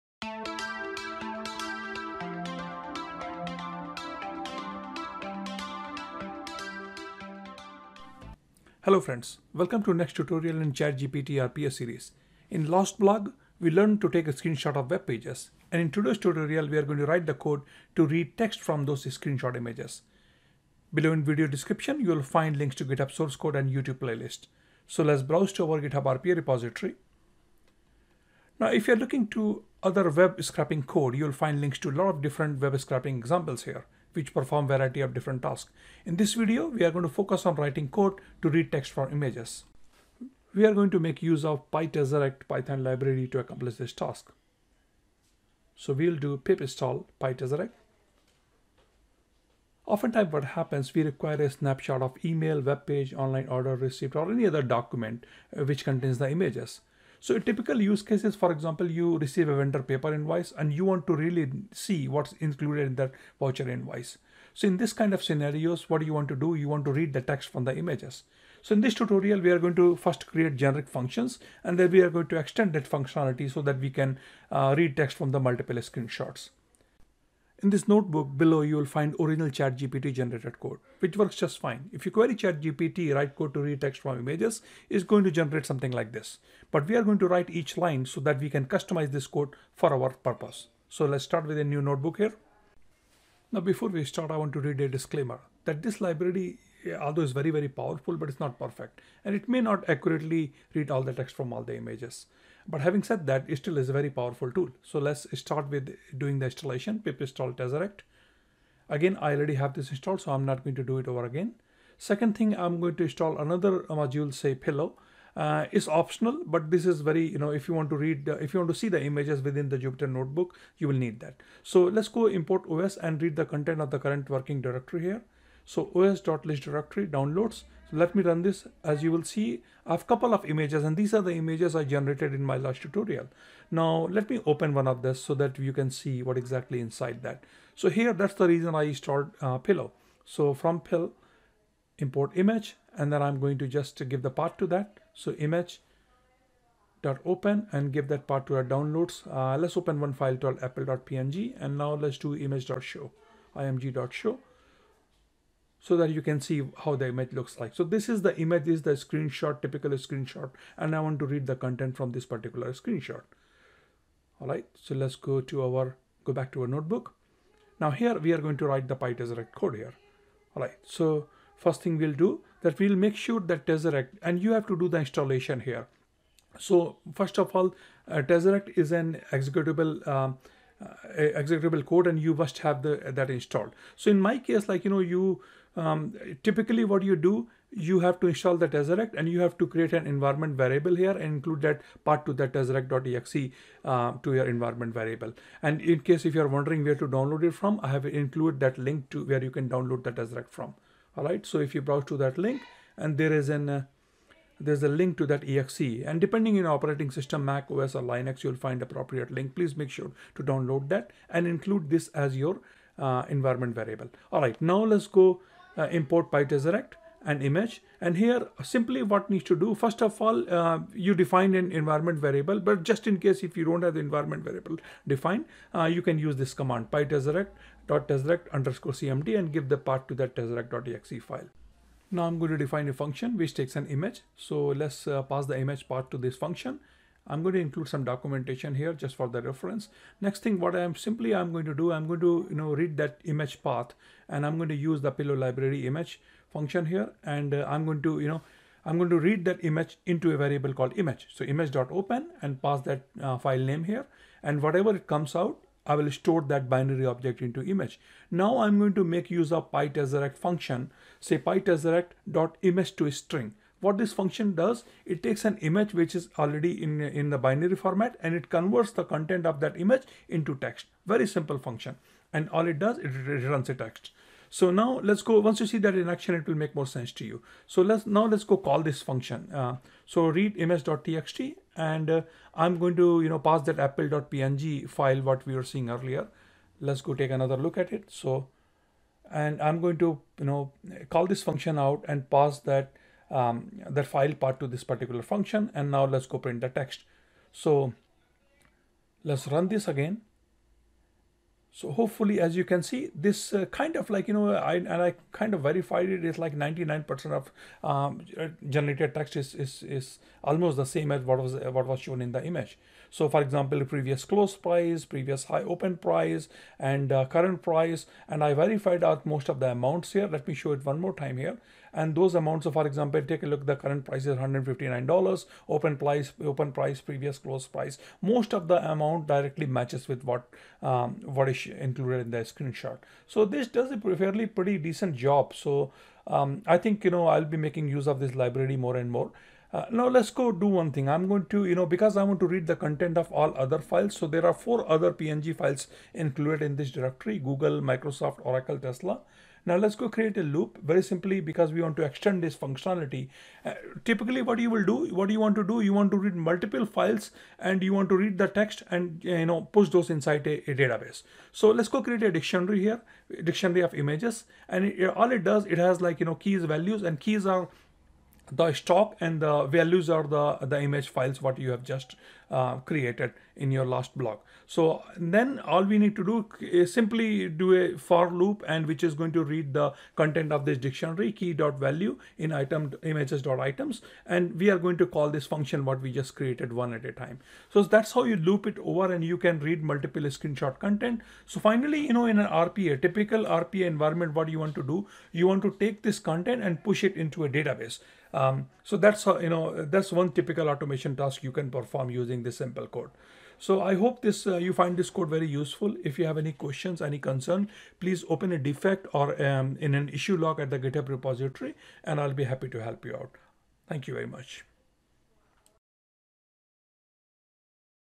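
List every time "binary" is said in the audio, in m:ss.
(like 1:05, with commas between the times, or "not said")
4:16, 4:27.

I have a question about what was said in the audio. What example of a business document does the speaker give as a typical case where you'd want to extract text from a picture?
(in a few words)
vendor paper invoice.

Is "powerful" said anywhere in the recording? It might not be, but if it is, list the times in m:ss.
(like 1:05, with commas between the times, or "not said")
1:37, 1:44.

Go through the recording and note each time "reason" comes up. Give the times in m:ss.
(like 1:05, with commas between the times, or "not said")
2:18.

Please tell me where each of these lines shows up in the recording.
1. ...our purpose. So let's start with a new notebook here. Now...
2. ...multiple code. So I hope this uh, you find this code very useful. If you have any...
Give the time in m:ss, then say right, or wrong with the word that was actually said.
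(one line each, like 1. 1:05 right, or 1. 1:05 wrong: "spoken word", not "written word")
1. 1:29 right
2. 6:42 wrong: "simple", not "multiple".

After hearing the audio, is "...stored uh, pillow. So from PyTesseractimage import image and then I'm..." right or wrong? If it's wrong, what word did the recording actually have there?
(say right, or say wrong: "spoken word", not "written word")
wrong: "PIL", not "PyTesseractimage".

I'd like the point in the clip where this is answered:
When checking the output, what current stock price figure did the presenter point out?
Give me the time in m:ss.
5:24.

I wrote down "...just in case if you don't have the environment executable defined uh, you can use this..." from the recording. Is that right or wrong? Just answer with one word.
wrong.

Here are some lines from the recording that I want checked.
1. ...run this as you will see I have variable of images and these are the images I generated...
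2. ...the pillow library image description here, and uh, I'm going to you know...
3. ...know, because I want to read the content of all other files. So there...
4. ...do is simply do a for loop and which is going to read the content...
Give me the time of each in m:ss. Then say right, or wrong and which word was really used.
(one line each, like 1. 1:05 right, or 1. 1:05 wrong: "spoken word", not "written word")
1. 2:08 wrong: "couple", not "variable"
2. 4:05 wrong: "function", not "description"
3. 5:41 right
4. 6:16 right.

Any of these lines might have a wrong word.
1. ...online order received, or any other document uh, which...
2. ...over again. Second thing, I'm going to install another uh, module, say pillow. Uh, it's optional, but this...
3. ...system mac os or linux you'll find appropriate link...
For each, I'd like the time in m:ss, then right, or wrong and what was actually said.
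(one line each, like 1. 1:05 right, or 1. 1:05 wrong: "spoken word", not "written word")
1. 0:53 right
2. 1:51 right
3. 3:27 right.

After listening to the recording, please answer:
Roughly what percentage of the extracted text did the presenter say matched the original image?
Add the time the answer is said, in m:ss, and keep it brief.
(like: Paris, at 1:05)
99%, at 5:06.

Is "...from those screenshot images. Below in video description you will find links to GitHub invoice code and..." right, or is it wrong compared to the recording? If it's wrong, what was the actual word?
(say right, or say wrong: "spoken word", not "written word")
wrong: "source", not "invoice".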